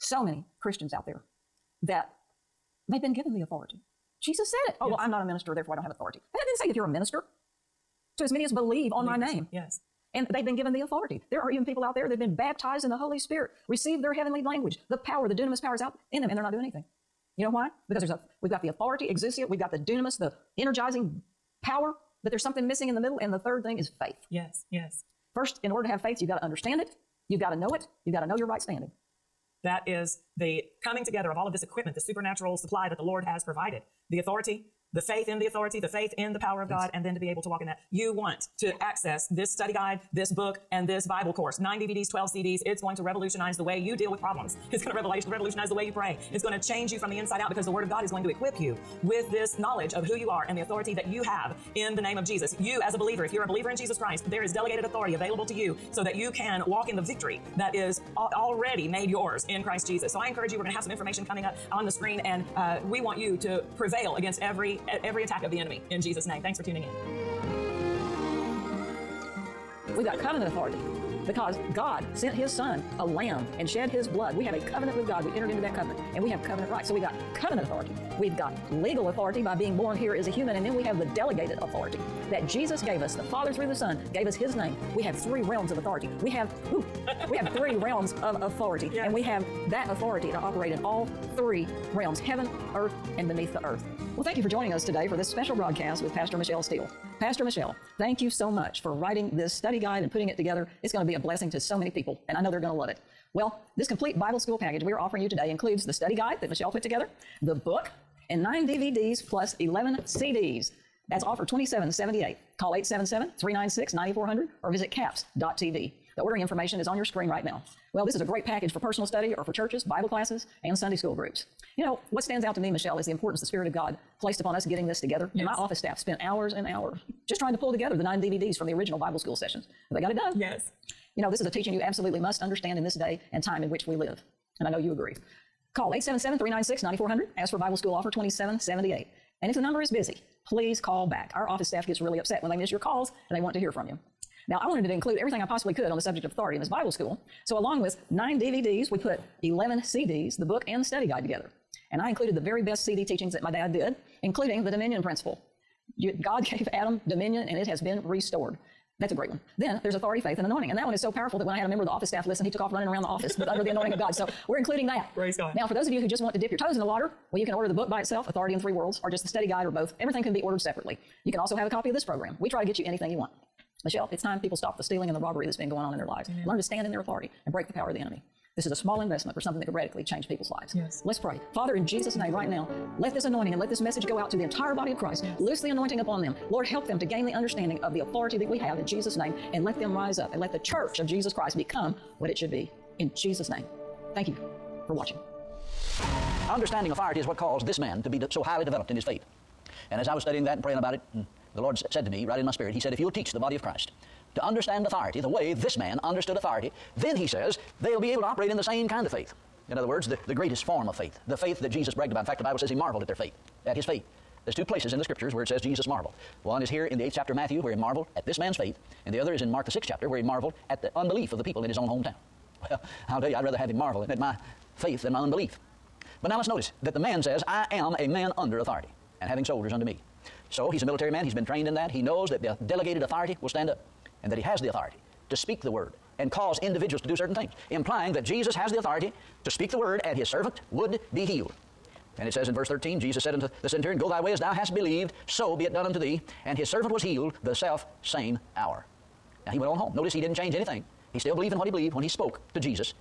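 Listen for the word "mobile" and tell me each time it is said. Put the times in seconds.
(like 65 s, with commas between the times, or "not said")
not said.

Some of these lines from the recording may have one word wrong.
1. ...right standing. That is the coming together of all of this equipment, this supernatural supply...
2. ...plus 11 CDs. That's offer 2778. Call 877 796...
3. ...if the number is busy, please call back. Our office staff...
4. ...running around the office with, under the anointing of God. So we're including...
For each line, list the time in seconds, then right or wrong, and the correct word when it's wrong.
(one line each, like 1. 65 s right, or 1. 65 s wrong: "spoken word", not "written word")
1. 28 s right
2. 109 s wrong: "396", not "796"
3. 139 s right
4. 162 s right.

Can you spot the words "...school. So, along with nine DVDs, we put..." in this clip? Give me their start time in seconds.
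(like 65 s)
146 s.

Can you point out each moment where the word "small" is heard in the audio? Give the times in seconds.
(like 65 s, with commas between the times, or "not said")
178 s.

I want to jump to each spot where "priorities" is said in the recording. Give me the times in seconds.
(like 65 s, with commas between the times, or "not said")
not said.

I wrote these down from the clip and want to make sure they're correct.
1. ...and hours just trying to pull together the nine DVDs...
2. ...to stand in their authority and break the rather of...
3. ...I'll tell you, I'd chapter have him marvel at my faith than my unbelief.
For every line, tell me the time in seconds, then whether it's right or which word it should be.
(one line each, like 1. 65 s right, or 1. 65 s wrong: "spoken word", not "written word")
1. 126 s right
2. 176 s wrong: "power", not "rather"
3. 223 s wrong: "rather", not "chapter".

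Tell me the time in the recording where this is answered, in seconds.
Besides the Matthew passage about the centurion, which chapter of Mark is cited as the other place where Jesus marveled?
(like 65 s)
219 s.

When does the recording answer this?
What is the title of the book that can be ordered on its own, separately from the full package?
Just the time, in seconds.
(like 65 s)
168 s.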